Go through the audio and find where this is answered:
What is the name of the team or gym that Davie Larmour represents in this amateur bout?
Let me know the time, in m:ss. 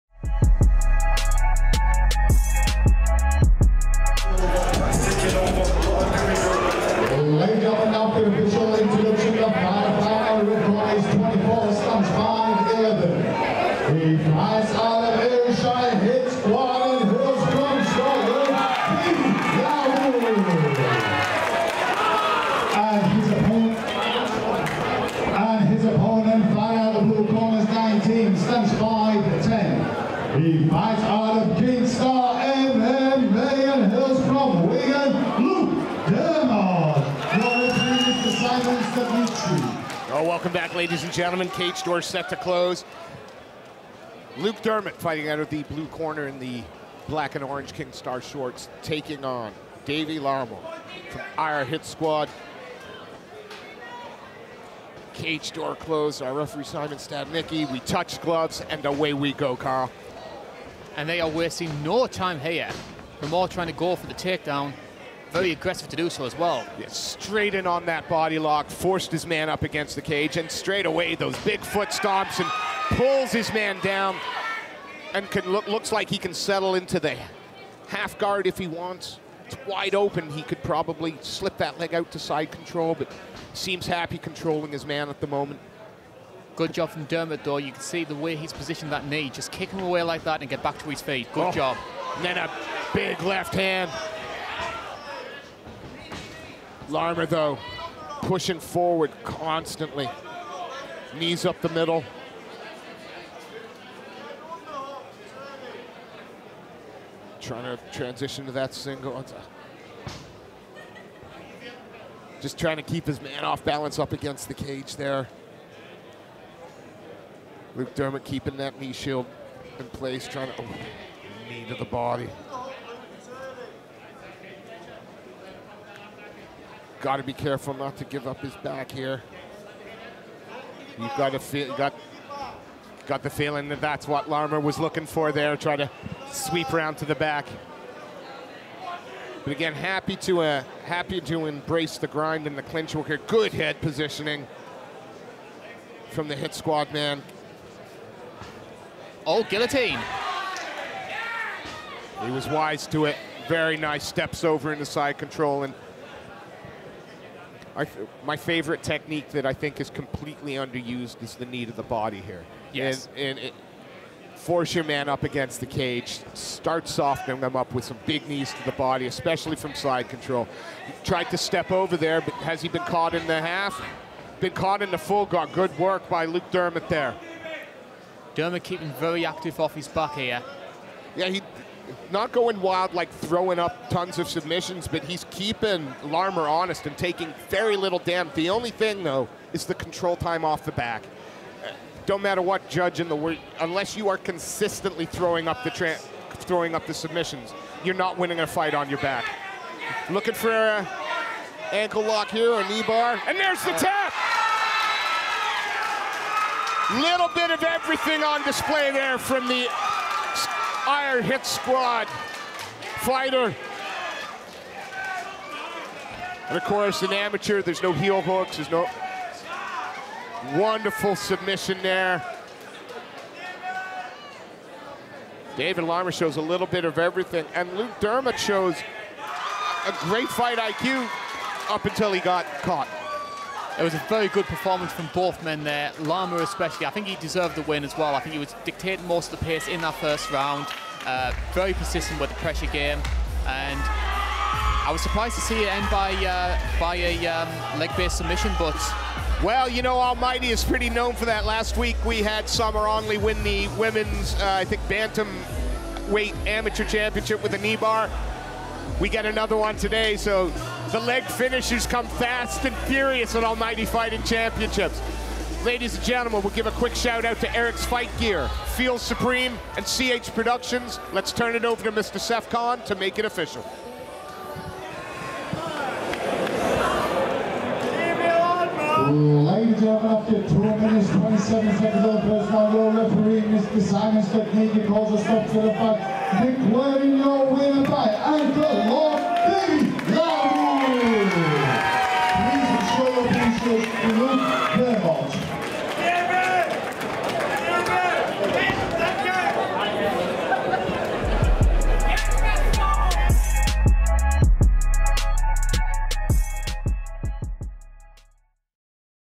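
0:51.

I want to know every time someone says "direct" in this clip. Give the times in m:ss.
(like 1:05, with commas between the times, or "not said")
not said.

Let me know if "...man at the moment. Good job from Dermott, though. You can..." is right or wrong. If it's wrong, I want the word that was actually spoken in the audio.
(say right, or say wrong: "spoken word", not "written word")
right.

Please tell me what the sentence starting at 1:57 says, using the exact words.
Luke Dermott keeping that knee shield in place, trying to oh, knee to the body.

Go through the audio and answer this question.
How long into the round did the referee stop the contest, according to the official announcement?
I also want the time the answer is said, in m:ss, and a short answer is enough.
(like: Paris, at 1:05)
2 minutes 27 seconds, at 4:40.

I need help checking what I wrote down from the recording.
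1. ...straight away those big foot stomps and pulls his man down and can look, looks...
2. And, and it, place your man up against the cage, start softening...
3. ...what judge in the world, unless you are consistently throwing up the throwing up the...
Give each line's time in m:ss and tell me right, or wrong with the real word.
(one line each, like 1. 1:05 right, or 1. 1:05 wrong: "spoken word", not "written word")
1. 1:10 right
2. 2:43 wrong: "force", not "place"
3. 3:12 right.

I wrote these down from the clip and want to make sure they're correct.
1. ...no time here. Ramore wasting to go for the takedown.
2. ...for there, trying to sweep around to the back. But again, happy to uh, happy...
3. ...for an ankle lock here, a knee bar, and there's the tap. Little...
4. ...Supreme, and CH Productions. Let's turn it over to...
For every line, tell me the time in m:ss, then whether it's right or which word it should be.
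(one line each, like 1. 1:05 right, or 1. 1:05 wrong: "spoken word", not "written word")
1. 1:01 wrong: "trying", not "wasting"
2. 2:15 right
3. 3:20 right
4. 4:28 right.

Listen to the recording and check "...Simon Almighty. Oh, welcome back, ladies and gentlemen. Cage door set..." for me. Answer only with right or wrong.
wrong.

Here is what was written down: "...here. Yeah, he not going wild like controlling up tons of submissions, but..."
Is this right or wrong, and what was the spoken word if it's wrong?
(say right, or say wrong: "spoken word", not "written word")
wrong: "throwing", not "controlling".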